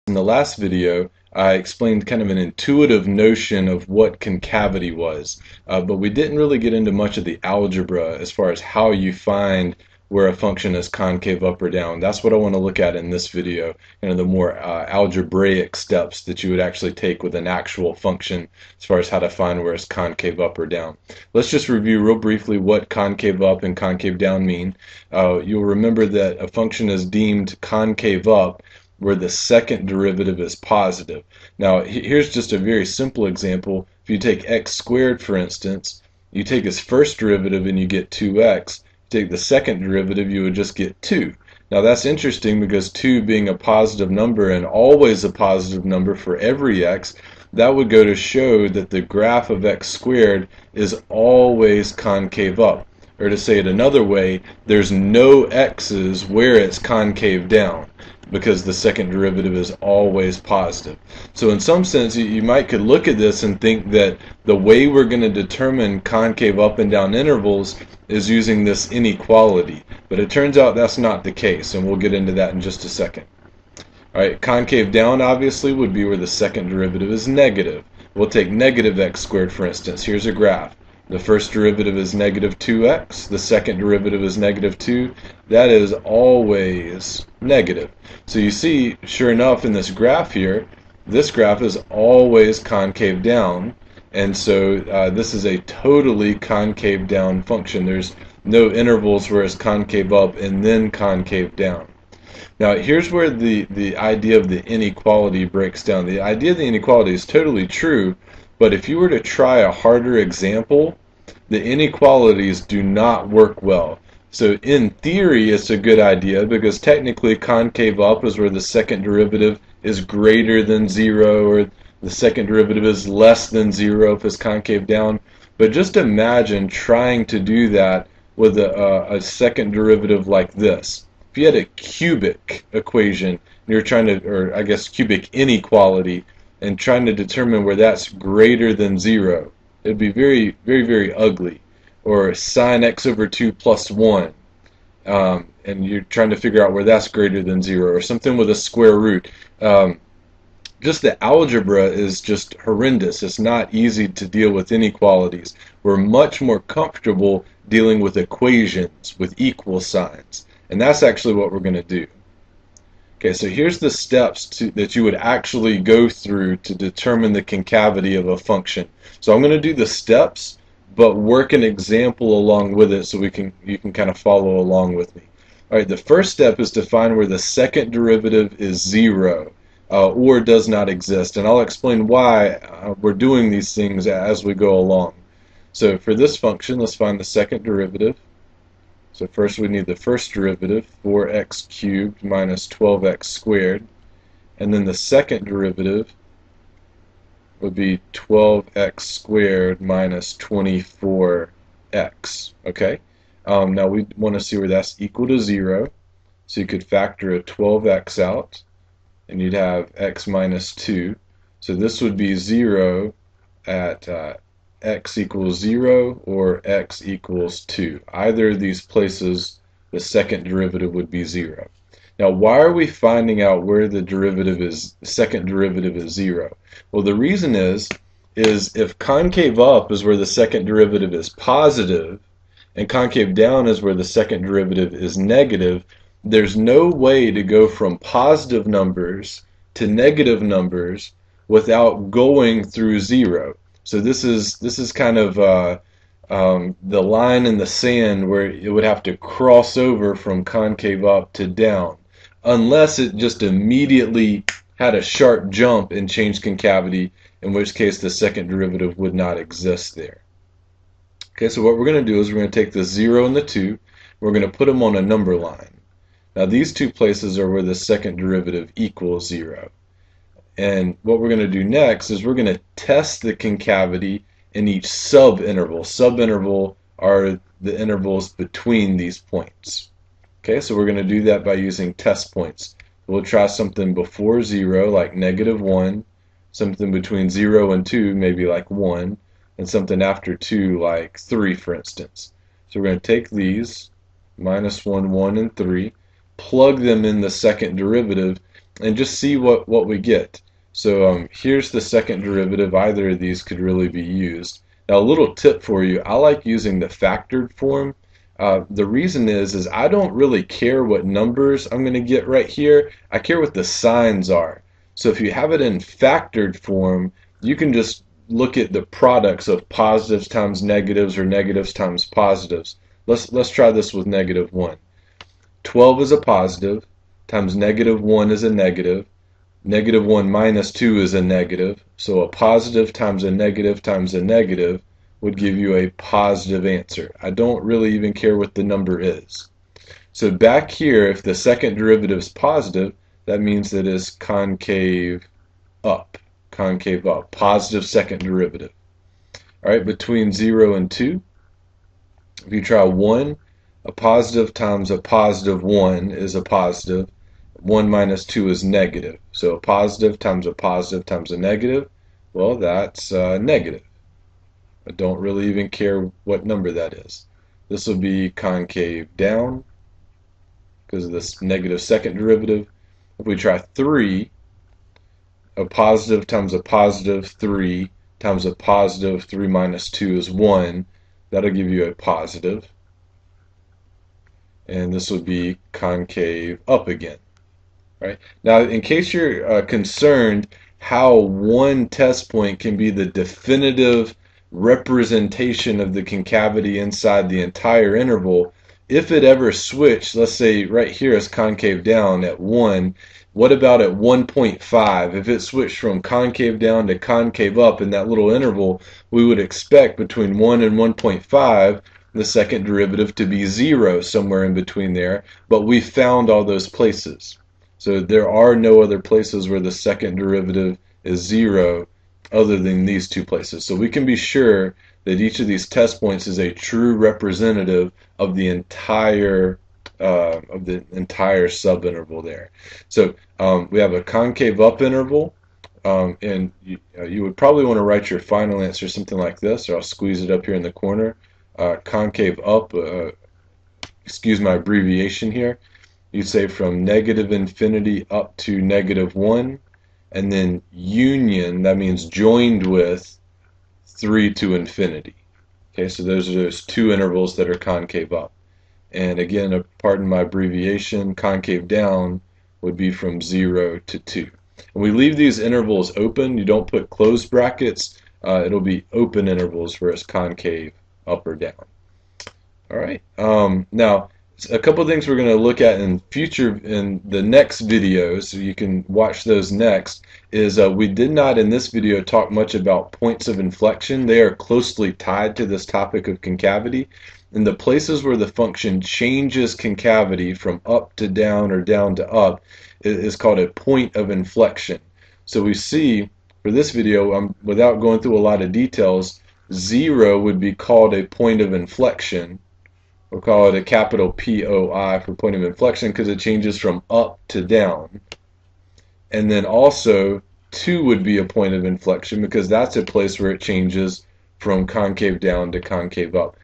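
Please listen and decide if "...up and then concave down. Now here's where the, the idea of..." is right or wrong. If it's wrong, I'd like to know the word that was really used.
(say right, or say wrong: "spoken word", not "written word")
right.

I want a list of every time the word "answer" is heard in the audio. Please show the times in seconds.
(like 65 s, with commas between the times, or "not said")
336 s, 438 s.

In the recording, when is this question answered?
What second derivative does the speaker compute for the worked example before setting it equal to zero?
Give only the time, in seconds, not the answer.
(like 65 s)
198 s.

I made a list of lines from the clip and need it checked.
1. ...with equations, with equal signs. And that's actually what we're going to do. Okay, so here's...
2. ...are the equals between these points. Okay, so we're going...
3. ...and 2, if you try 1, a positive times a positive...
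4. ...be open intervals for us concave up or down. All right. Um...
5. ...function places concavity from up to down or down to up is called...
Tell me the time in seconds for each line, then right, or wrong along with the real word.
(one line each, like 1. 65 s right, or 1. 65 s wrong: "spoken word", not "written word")
1. 157 s right
2. 276 s wrong: "intervals", not "equals"
3. 350 s right
4. 468 s right
5. 488 s wrong: "changes", not "places".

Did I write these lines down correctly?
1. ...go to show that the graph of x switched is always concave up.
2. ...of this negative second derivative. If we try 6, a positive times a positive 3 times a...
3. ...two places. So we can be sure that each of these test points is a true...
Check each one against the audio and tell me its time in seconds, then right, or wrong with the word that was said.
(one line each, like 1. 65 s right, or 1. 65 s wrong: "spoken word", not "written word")
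1. 47 s wrong: "squared", not "switched"
2. 371 s wrong: "3", not "6"
3. 423 s right.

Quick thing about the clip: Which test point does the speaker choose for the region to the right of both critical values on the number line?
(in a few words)
3.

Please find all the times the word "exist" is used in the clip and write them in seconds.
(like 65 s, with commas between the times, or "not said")
180 s, 259 s.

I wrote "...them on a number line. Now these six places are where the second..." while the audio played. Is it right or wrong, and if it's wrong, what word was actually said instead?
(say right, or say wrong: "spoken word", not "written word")
wrong: "two", not "six".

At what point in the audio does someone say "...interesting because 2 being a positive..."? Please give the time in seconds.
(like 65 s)
42 s.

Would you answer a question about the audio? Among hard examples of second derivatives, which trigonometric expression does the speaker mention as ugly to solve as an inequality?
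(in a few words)
sin(x/2) + 1.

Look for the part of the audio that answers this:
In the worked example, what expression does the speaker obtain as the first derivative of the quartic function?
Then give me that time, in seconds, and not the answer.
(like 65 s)
191 s.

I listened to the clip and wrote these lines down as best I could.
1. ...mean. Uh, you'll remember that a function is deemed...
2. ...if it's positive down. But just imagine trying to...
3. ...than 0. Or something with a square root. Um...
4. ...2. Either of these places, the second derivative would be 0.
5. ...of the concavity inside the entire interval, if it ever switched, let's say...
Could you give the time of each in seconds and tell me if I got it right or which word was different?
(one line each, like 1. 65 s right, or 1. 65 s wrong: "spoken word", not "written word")
1. 24 s right
2. 124 s wrong: "concave", not "positive"
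3. 147 s right
4. 217 s right
5. 395 s right.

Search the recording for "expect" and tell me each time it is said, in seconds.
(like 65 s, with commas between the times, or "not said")
409 s.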